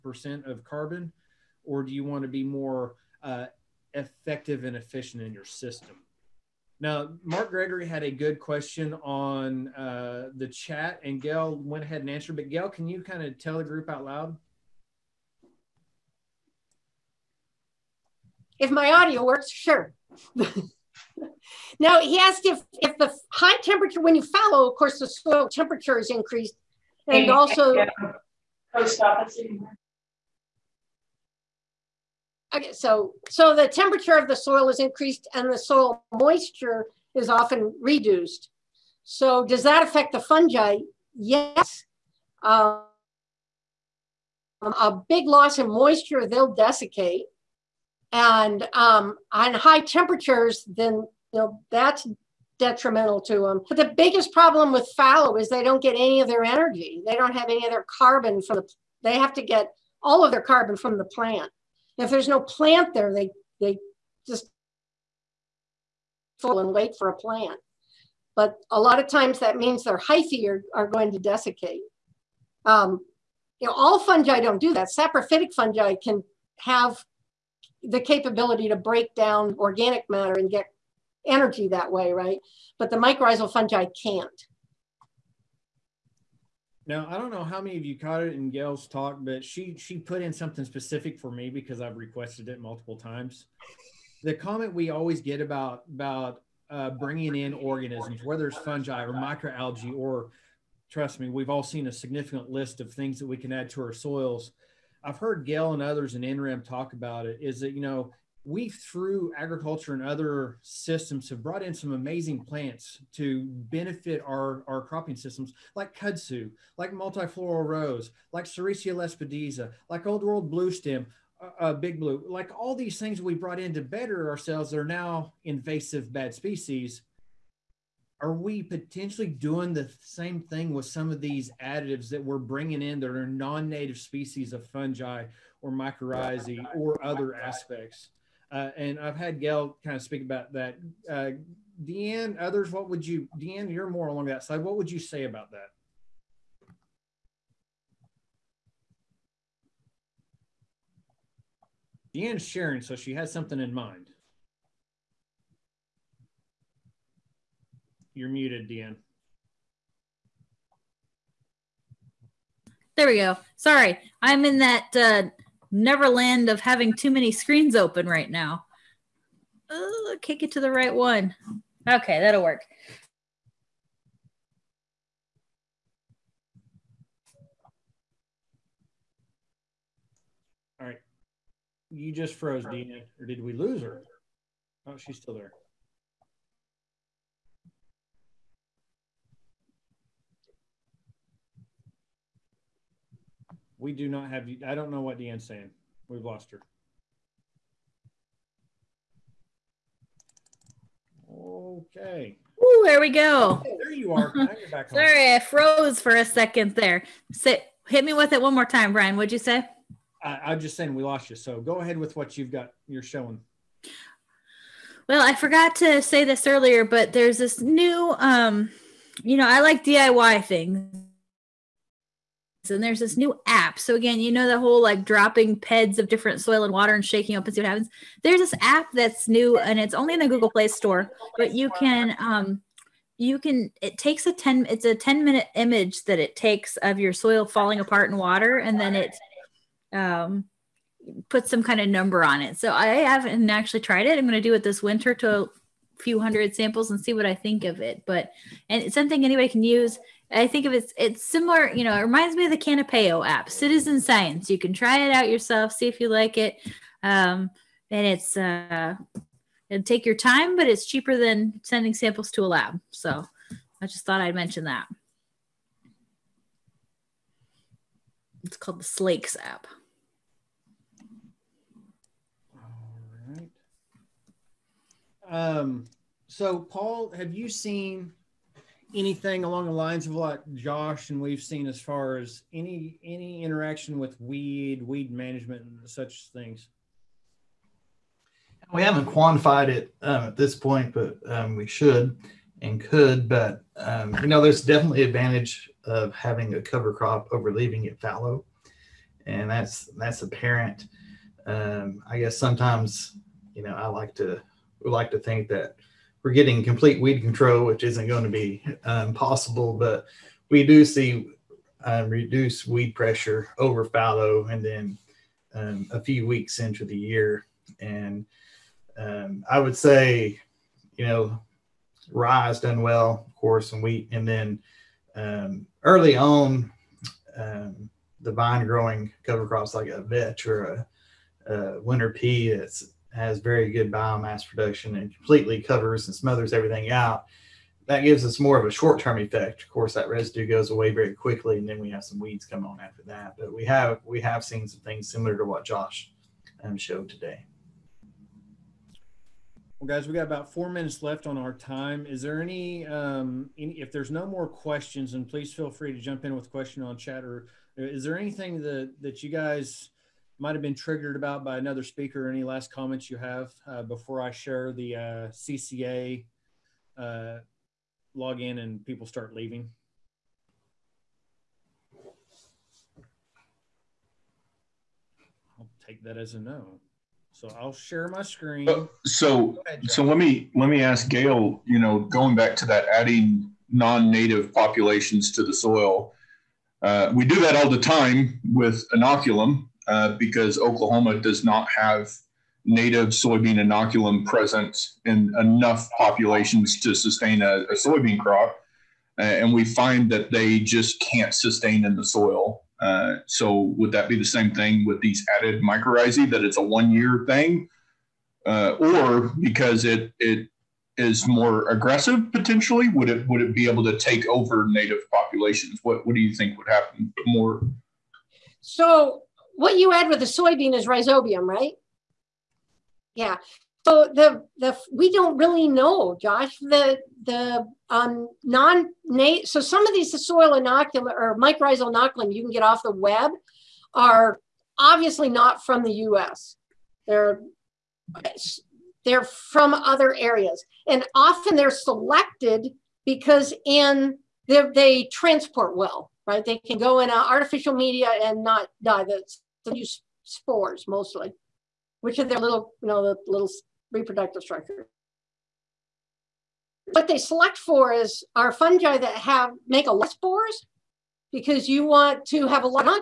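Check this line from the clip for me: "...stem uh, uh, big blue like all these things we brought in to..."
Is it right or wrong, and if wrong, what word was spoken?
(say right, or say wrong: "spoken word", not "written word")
right.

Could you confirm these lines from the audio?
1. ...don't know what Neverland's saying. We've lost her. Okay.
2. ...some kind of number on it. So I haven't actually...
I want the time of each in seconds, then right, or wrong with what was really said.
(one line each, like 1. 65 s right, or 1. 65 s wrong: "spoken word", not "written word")
1. 194 s wrong: "Deanne", not "Neverland"
2. 241 s right.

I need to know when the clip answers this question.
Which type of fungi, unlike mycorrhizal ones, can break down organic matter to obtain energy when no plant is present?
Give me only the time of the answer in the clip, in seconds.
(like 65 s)
74 s.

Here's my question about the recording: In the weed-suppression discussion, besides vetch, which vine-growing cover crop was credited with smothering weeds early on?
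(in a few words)
Winter pea.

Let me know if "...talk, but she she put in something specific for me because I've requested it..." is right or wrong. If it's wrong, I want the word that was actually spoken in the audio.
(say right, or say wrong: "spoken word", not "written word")
right.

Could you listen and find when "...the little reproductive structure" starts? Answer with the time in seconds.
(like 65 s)
453 s.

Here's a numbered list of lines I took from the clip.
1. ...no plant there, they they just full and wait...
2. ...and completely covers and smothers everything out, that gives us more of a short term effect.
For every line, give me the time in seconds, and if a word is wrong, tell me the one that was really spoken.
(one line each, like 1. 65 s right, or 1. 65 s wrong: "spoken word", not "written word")
1. 62 s right
2. 334 s right.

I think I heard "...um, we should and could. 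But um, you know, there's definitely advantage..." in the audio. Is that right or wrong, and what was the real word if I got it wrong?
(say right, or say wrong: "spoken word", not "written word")
right.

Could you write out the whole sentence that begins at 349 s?
Well, guys, we got about four minutes left on our time.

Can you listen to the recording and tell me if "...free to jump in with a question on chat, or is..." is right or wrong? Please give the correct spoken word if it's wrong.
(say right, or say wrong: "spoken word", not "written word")
right.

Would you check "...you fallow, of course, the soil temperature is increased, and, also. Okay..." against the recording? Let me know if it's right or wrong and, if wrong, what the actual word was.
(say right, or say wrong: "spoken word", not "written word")
right.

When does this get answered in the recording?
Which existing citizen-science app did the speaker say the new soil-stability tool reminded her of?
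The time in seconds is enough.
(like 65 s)
252 s.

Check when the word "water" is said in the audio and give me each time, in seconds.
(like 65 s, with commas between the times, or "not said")
226 s, 238 s.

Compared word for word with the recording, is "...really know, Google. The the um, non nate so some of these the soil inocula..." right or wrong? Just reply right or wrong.
wrong.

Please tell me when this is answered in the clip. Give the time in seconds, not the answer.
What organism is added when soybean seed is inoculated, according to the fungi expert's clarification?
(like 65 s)
420 s.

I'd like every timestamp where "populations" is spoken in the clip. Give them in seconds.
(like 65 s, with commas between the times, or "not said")
384 s, 395 s, 415 s.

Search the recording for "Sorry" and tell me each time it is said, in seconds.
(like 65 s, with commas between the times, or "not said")
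163 s, 204 s.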